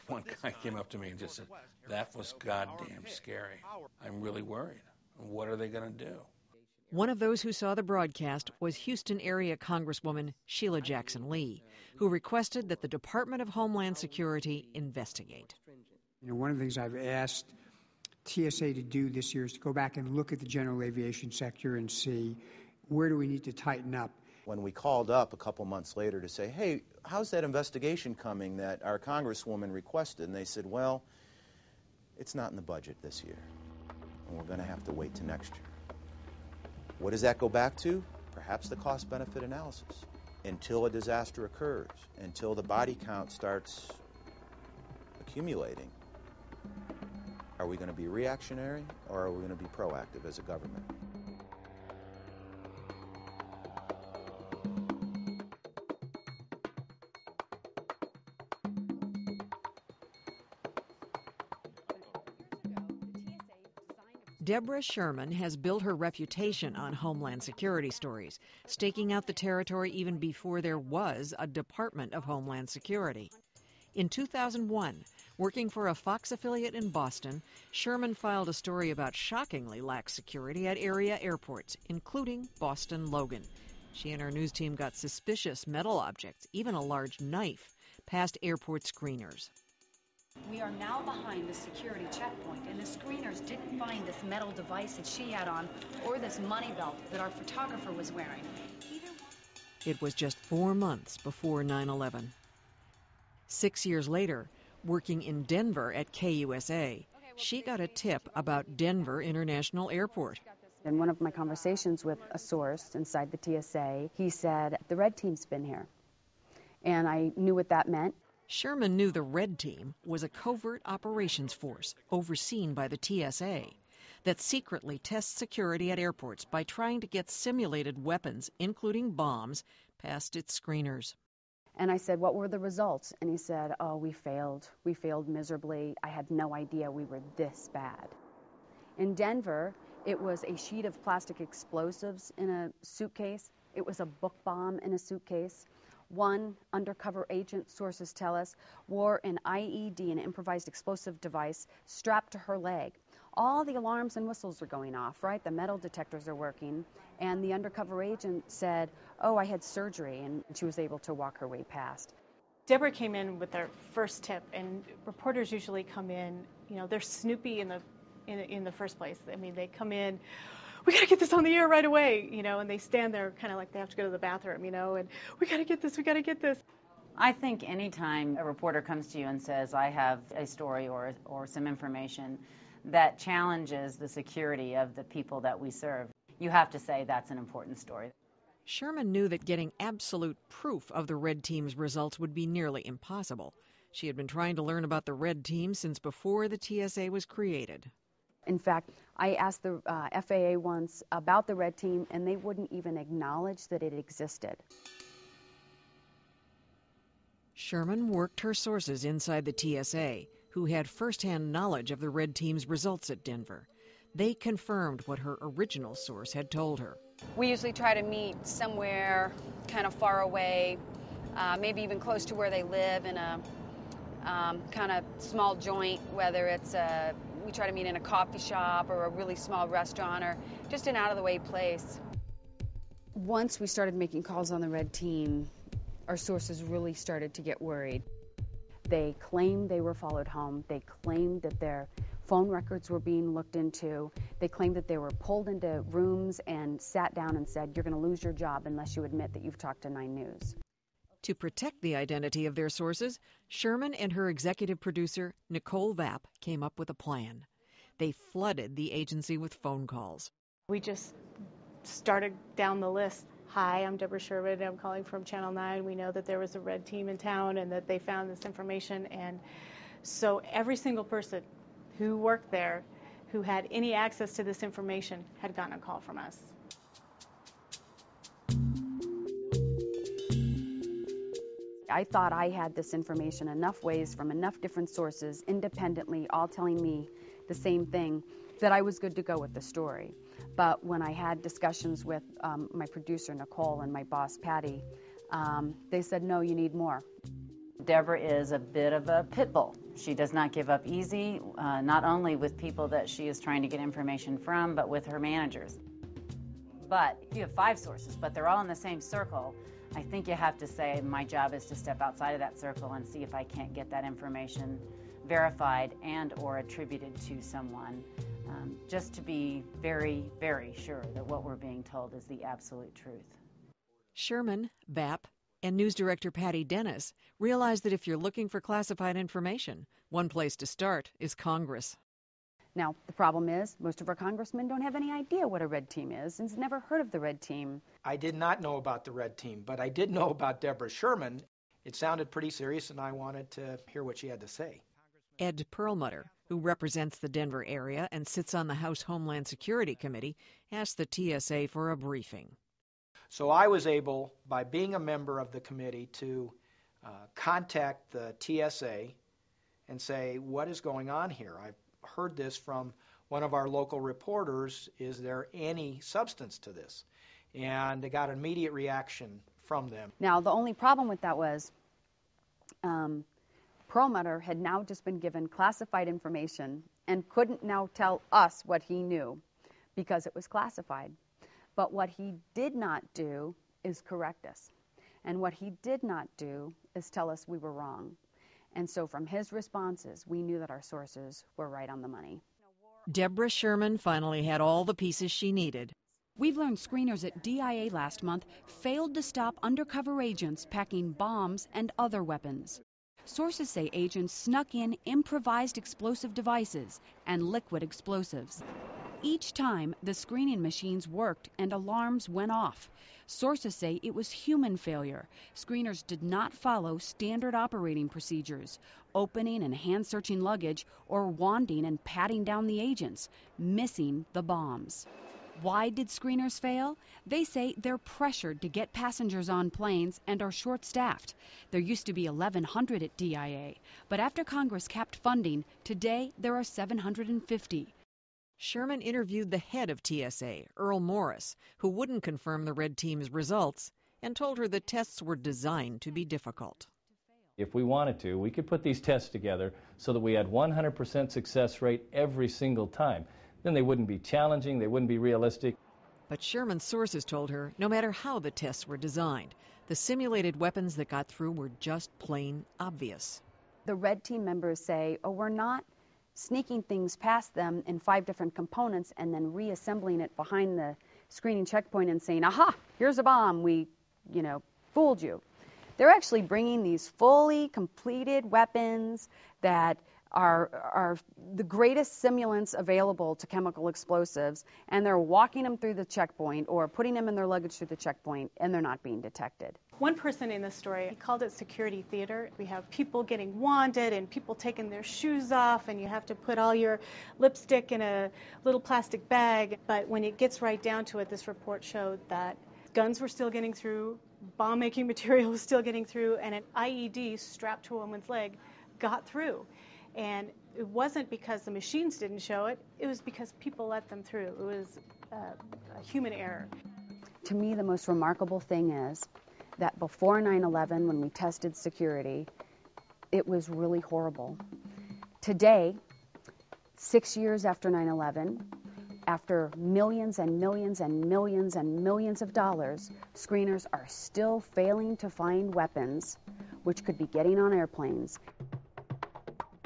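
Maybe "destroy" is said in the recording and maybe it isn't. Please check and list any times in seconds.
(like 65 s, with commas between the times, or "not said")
not said.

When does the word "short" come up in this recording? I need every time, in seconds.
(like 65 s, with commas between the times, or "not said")
430 s.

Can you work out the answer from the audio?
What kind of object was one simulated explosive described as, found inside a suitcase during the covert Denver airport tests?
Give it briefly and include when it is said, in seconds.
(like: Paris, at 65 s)
book bomb, at 144 s.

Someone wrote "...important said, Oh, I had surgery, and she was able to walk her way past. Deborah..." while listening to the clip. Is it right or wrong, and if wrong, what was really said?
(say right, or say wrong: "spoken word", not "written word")
wrong: "agent", not "important".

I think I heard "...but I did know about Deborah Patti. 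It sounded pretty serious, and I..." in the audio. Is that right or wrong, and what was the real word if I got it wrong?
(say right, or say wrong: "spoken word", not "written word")
wrong: "Sherman", not "Patti".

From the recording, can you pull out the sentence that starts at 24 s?
When we called up a couple months later to say, hey, how's that investigation coming that our Congresswoman requested?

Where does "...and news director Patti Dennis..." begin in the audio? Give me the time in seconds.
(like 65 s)
325 s.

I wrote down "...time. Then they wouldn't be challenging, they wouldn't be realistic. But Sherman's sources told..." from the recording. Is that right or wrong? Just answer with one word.
right.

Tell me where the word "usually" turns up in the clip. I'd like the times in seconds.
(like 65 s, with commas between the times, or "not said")
165 s, 217 s.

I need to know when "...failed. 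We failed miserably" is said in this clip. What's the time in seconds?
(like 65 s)
134 s.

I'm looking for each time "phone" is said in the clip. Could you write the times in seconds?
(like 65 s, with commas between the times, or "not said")
242 s, 259 s.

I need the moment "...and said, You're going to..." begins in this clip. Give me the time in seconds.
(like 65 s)
247 s.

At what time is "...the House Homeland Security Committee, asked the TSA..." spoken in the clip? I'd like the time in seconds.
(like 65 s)
348 s.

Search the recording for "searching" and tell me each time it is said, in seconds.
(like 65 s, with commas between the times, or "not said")
420 s.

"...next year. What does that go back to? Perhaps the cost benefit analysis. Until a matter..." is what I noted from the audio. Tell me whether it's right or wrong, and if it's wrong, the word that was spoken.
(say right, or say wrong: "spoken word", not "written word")
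wrong: "disaster", not "matter".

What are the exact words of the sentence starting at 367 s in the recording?
And they got an immediate reaction from them.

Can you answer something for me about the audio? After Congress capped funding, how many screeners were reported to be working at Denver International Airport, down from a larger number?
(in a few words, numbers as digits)
750.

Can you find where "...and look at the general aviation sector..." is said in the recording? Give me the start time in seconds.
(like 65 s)
19 s.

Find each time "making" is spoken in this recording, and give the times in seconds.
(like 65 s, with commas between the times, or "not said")
233 s, 504 s.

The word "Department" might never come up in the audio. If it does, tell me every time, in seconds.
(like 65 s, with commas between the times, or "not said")
12 s, 71 s.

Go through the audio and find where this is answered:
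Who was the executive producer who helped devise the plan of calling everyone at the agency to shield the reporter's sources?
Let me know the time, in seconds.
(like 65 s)
255 s.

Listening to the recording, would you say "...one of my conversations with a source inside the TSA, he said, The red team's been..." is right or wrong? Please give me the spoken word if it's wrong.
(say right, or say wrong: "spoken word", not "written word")
right.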